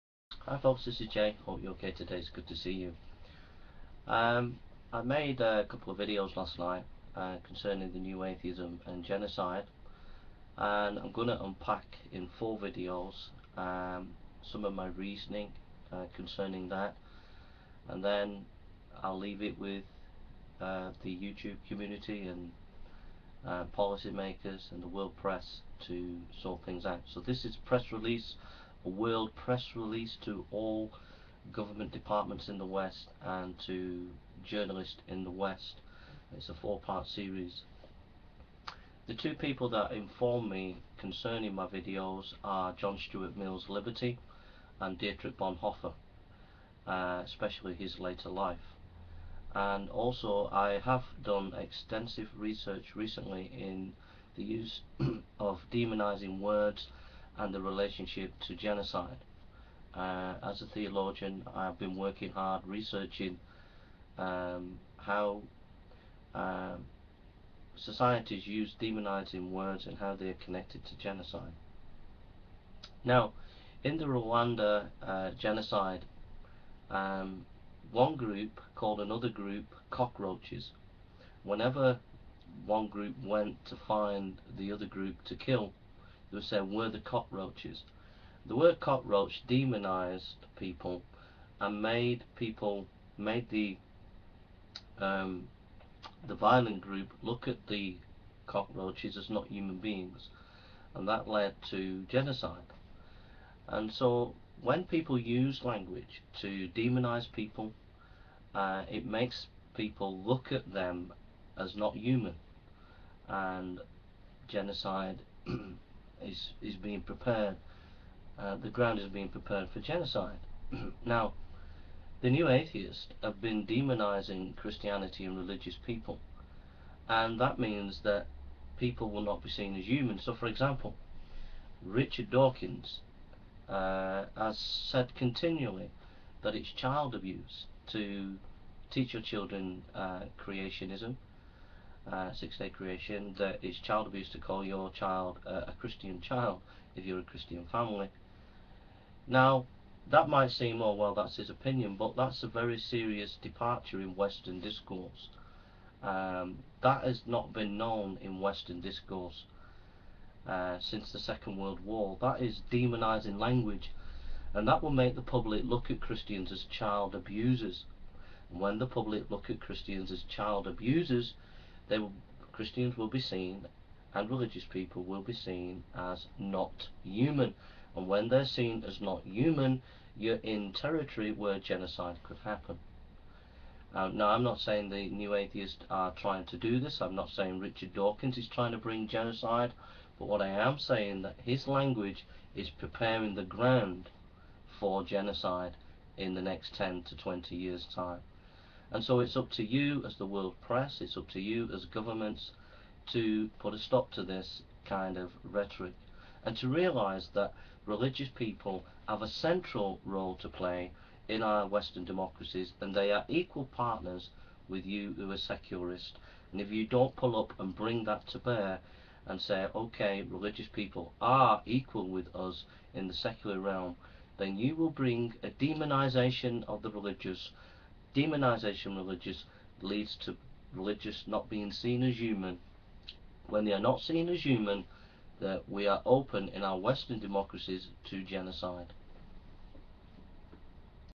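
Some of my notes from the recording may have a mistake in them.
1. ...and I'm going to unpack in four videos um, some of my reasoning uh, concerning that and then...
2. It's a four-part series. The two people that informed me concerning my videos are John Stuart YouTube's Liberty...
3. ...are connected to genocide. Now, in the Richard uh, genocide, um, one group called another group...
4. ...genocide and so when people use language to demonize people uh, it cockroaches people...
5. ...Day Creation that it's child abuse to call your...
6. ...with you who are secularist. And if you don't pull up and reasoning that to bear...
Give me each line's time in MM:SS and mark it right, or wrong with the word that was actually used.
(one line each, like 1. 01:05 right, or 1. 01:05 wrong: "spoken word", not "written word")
1. 00:10 right
2. 00:36 wrong: "Mill", not "YouTube"
3. 01:10 wrong: "Rwanda", not "Richard"
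4. 01:42 wrong: "makes", not "cockroaches"
5. 02:22 right
6. 03:34 wrong: "bring", not "reasoning".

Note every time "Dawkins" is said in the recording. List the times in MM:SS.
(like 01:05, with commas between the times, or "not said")
02:12, 03:07.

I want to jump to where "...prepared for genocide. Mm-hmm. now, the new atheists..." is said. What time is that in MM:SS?
01:59.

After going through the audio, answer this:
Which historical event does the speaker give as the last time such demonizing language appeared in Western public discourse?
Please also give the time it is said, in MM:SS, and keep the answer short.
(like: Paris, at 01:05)
Second World War, at 02:41.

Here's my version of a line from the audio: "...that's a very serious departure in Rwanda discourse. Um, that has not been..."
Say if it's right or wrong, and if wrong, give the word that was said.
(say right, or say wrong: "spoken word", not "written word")
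wrong: "Western", not "Rwanda".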